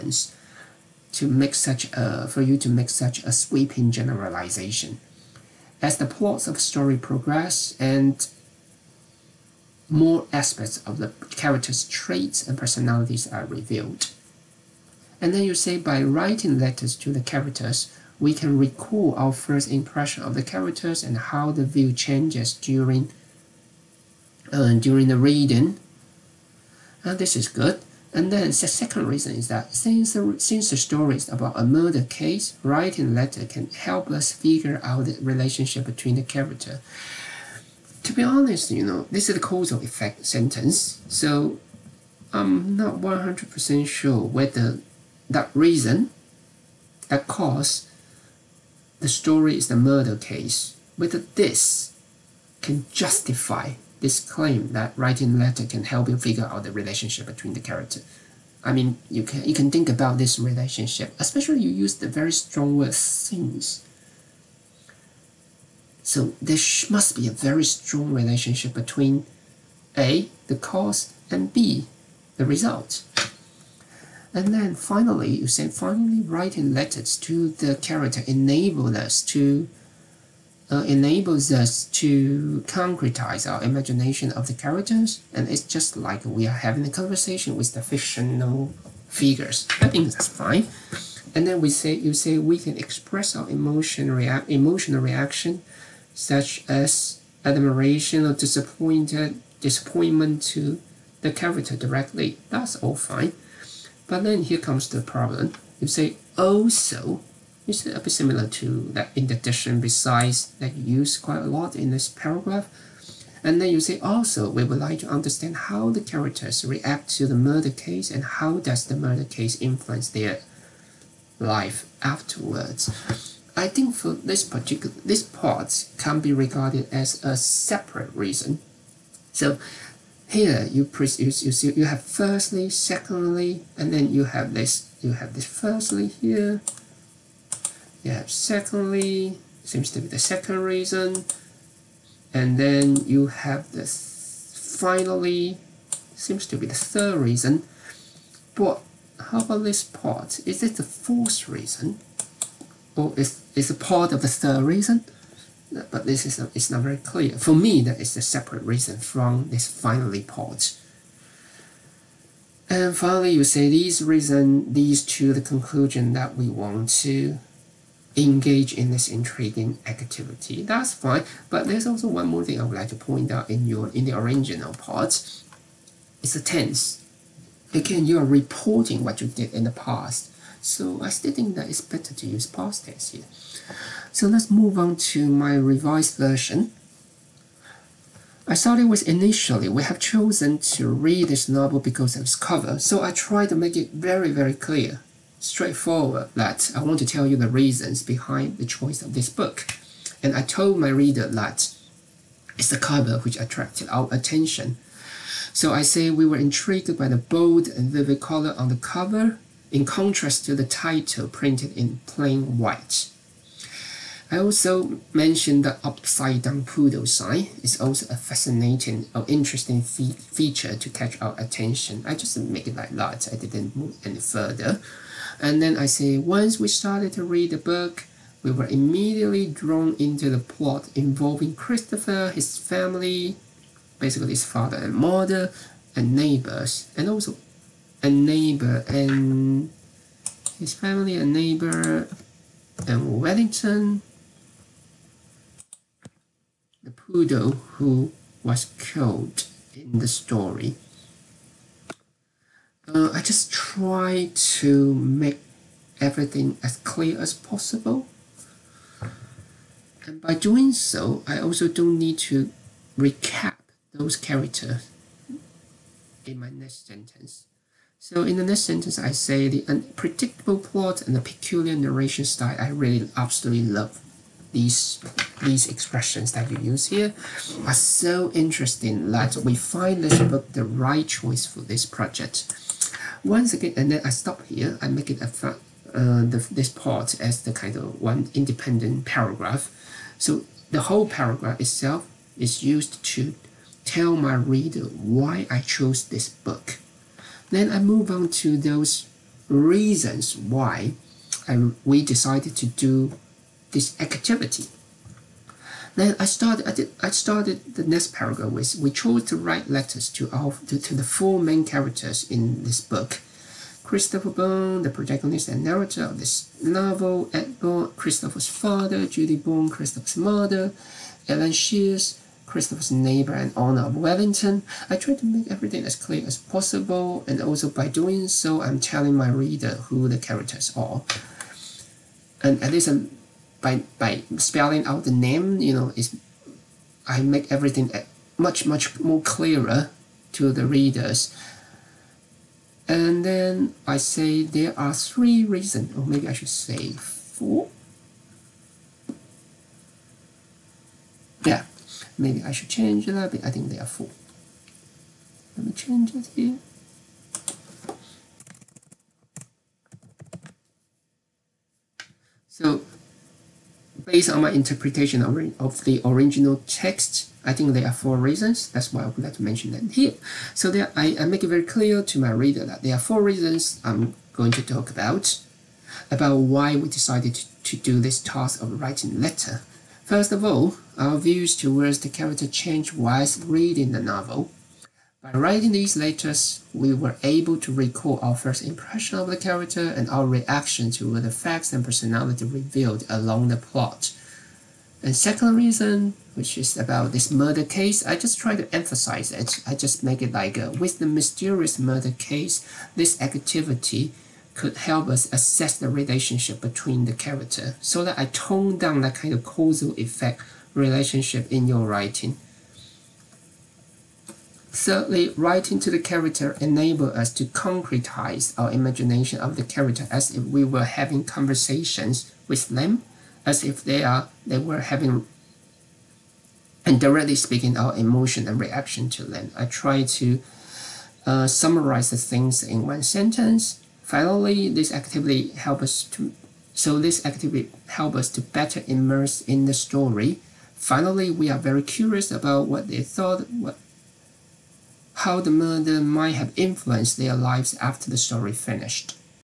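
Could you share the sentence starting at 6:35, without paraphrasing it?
And second reason, which is about this murder case, I just try to emphasize it.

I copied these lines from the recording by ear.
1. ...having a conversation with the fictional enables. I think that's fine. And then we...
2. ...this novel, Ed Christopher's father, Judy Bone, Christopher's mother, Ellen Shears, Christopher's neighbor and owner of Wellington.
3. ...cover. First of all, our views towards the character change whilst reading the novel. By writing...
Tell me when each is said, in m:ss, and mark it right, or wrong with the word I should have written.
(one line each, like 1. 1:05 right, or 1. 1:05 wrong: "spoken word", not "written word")
1. 1:26 wrong: "figures", not "enables"
2. 5:16 right
3. 6:19 wrong: "letter", not "cover".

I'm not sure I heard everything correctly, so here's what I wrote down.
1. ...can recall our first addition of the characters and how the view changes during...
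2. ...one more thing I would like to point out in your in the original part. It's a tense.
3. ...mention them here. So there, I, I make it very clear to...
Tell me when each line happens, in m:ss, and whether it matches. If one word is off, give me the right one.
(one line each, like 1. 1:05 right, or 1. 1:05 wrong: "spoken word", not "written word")
1. 0:18 wrong: "impression", not "addition"
2. 2:52 right
3. 6:09 right.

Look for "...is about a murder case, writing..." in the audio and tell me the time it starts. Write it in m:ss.
0:31.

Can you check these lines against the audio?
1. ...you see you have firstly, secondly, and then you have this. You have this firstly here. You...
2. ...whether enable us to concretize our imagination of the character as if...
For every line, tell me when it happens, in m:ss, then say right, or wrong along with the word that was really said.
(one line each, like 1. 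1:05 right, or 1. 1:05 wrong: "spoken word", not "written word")
1. 2:11 right
2. 6:55 wrong: "character", not "whether".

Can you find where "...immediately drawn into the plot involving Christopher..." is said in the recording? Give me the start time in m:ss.
3:48.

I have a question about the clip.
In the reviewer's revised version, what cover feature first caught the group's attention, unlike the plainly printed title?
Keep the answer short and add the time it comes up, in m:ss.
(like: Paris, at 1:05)
bold and vivid color, at 3:27.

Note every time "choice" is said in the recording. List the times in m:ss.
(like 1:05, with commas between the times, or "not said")
3:18, 4:41.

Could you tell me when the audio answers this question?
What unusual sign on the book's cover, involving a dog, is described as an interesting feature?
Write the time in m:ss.
3:35.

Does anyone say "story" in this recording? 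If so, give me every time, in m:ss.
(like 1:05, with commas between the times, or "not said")
0:06, 0:30, 0:49, 4:10, 7:19, 7:28.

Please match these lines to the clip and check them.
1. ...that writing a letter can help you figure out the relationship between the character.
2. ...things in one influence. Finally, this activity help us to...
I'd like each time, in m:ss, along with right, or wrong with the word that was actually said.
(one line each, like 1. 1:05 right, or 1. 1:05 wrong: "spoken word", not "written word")
1. 0:54 right
2. 7:12 wrong: "sentence", not "influence".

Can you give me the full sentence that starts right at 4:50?
So the whole paragraph itself is used to tell my reader why I chose this book.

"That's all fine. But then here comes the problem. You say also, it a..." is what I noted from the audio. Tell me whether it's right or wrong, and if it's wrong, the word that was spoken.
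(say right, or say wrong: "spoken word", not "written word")
right.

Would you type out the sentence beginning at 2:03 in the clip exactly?
I think for this particular, this part can be regarded as a separate reason.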